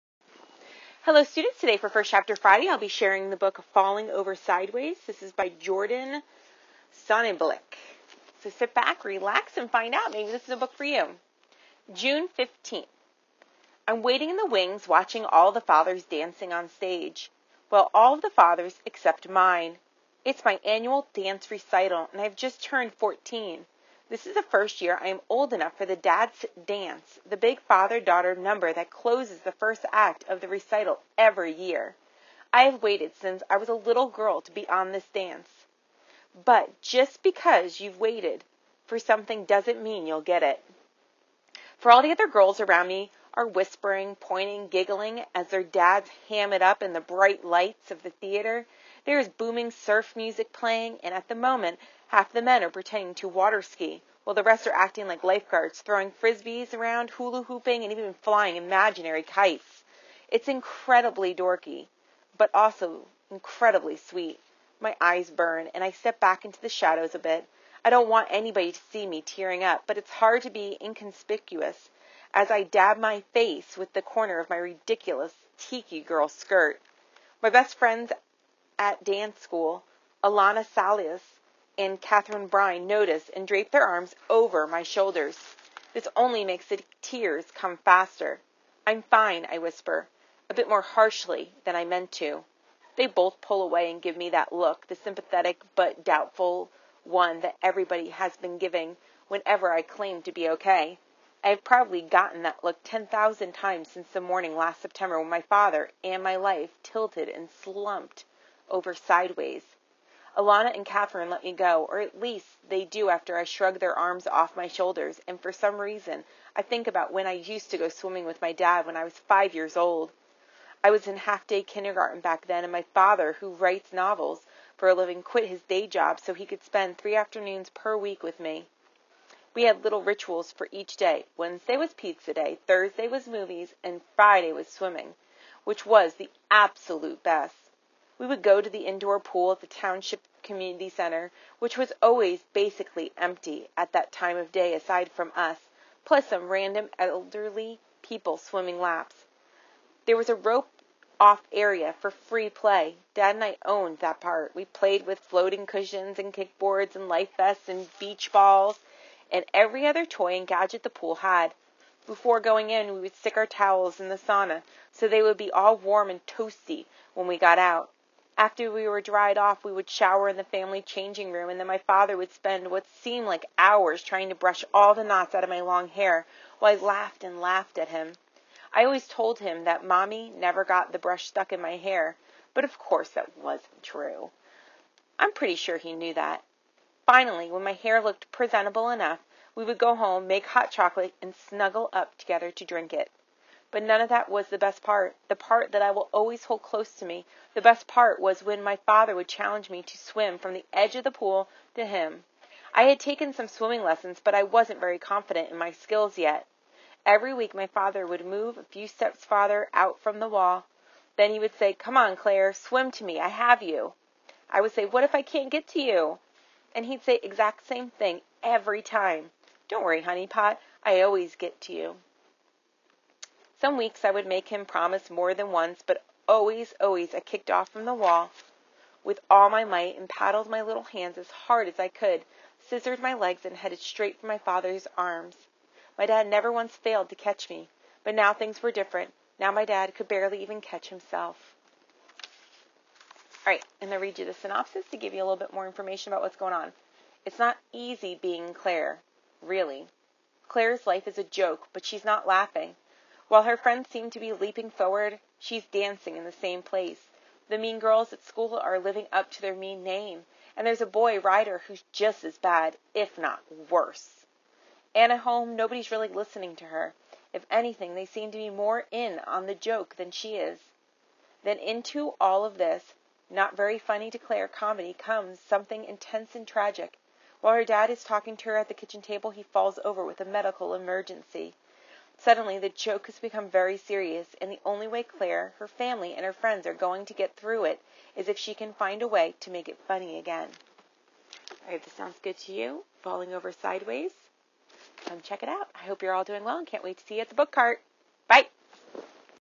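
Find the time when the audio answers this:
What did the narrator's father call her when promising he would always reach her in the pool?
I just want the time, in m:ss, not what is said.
3:40.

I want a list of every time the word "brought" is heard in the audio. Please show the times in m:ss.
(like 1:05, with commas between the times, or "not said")
not said.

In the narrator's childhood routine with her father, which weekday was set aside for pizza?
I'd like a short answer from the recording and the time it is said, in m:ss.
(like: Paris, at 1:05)
Wednesday, at 2:11.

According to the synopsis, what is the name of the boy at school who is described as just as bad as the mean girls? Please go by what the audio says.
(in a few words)
Ryder.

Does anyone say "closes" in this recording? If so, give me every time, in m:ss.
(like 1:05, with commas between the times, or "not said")
0:28, 3:16.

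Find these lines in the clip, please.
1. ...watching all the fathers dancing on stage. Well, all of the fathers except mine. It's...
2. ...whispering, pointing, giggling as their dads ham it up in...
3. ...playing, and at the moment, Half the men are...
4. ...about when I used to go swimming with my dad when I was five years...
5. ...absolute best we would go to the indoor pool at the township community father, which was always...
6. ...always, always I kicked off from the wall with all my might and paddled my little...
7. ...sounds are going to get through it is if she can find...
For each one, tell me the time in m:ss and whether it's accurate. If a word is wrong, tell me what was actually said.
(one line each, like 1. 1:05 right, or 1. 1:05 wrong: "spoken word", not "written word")
1. 0:14 right
2. 0:43 right
3. 0:50 right
4. 1:56 right
5. 2:16 wrong: "center", not "father"
6. 3:46 right
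7. 4:46 wrong: "friends", not "sounds".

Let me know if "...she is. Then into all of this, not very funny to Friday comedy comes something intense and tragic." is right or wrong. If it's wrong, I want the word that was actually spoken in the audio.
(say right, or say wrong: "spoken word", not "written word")
wrong: "Claire", not "Friday".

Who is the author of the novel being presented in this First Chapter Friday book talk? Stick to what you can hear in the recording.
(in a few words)
Jordan Sonnenblick.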